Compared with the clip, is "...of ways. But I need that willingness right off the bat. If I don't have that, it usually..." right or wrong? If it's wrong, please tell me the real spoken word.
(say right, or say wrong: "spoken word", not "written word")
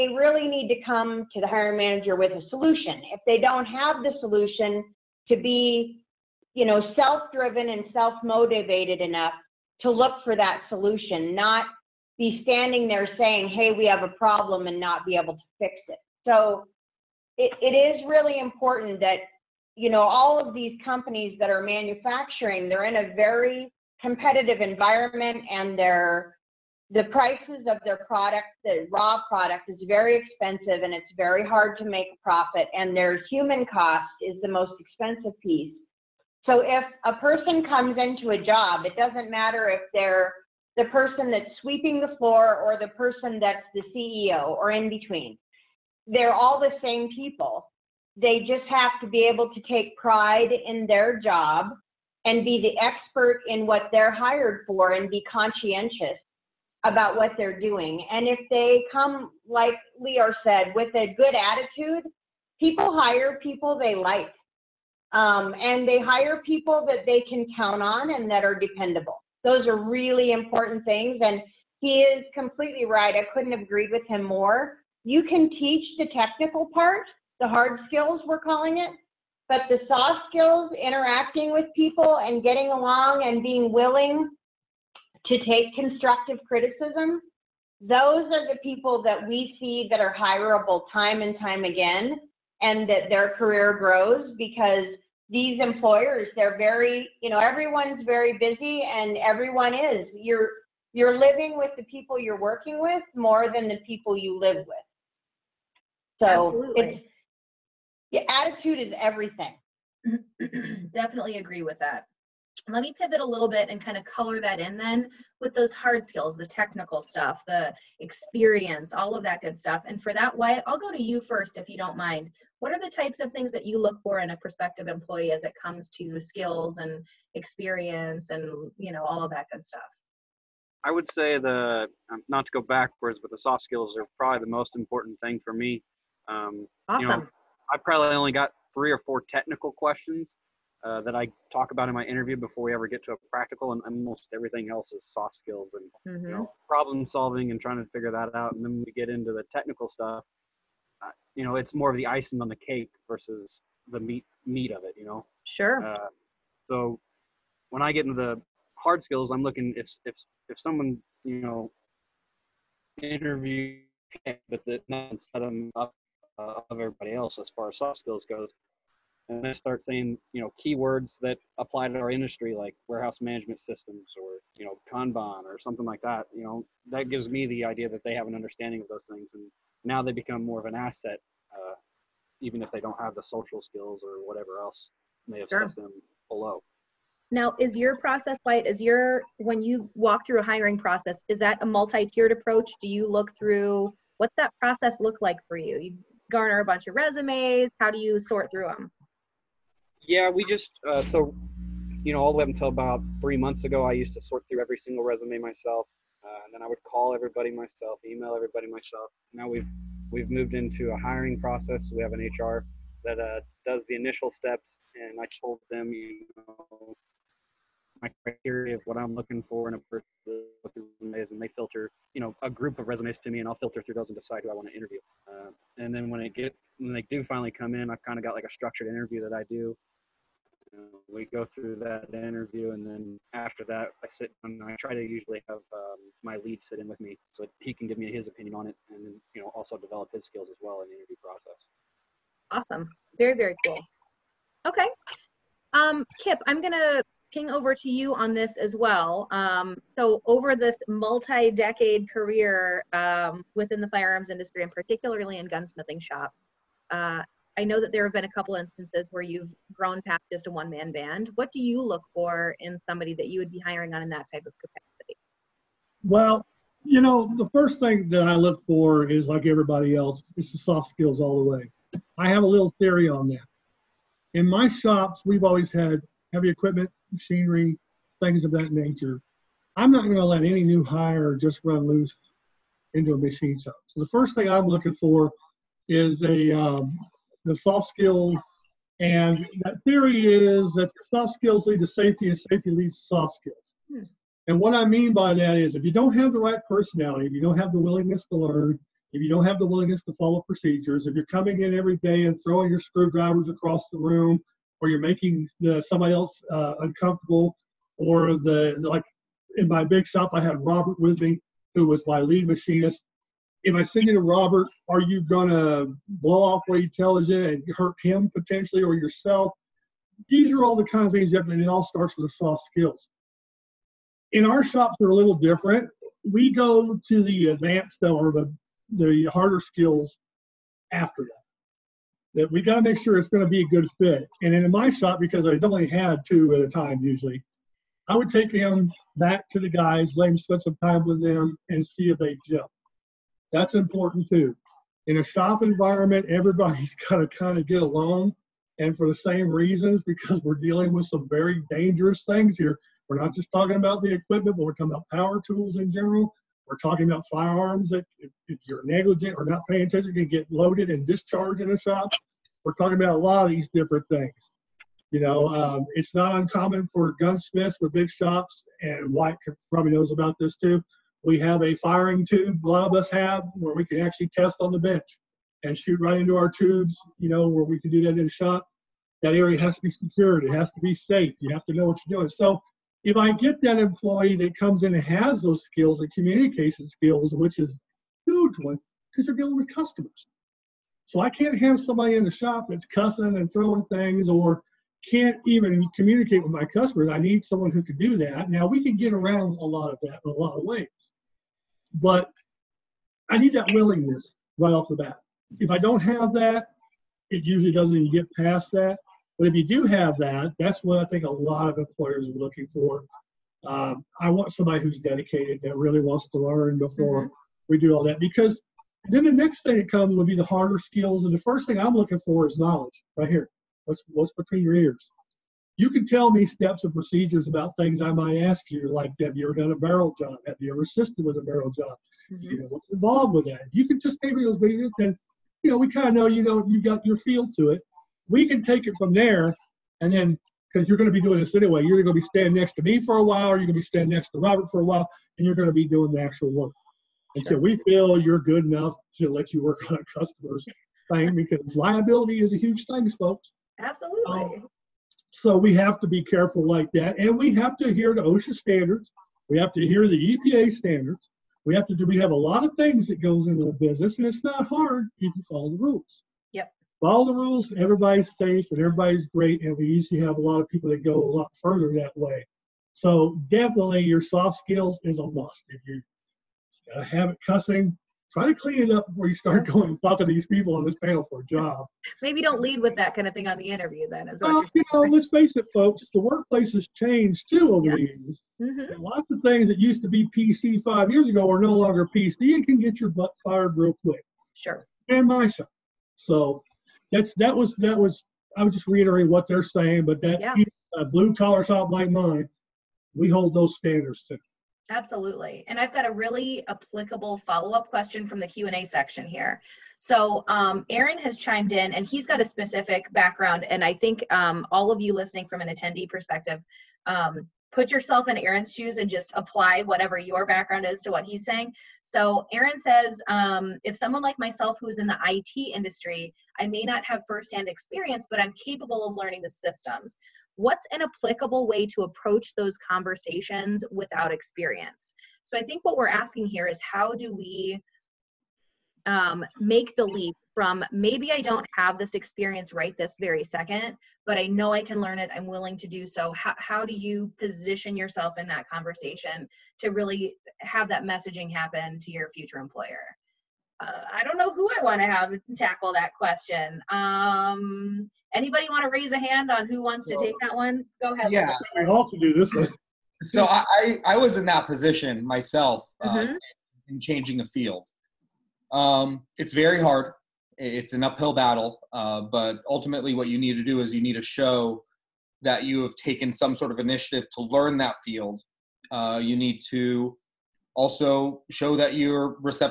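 right.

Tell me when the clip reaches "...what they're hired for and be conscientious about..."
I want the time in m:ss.
0:53.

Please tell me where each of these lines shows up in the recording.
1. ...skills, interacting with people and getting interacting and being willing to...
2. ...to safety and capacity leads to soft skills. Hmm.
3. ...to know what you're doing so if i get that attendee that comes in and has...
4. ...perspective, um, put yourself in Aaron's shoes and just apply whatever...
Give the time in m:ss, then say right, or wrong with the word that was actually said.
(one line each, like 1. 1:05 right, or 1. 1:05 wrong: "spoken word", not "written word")
1. 1:20 wrong: "along", not "interacting"
2. 4:51 wrong: "safety", not "capacity"
3. 6:21 wrong: "employee", not "attendee"
4. 8:36 right.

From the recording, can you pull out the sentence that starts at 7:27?
Until we feel you're good enough to let you work on a customer's thing, because liability is a huge thing, folks.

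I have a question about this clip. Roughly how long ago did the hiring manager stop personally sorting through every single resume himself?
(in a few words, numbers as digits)
3 months.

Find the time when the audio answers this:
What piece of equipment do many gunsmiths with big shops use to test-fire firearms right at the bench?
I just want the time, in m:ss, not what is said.
6:11.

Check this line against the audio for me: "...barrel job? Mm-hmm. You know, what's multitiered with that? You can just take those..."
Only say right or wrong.
wrong.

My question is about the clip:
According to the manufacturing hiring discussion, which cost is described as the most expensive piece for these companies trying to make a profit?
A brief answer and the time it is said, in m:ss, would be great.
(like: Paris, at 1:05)
human cost, at 0:33.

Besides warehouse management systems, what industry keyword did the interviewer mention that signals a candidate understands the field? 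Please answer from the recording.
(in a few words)
kanban.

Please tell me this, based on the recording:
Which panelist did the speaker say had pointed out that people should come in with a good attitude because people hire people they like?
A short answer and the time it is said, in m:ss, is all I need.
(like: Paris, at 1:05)
Leeor, at 0:59.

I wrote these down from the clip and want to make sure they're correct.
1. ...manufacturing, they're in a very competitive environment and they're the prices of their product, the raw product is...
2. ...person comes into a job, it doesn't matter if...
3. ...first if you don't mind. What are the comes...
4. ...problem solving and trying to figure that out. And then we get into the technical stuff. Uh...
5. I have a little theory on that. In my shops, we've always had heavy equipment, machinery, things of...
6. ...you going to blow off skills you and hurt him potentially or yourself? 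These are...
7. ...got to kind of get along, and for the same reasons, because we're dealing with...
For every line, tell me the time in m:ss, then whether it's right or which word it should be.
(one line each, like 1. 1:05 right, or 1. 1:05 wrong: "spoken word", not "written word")
1. 0:21 right
2. 0:37 right
3. 2:01 wrong: "types", not "comes"
4. 2:26 right
5. 4:32 right
6. 5:15 wrong: "tells", not "skills"
7. 5:47 right.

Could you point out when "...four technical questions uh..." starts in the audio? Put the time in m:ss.
2:19.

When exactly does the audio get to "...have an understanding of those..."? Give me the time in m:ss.
2:58.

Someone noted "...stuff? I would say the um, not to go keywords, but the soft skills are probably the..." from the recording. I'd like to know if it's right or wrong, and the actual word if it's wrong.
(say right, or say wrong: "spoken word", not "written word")
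wrong: "backwards", not "keywords".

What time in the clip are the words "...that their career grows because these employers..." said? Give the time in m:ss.
1:32.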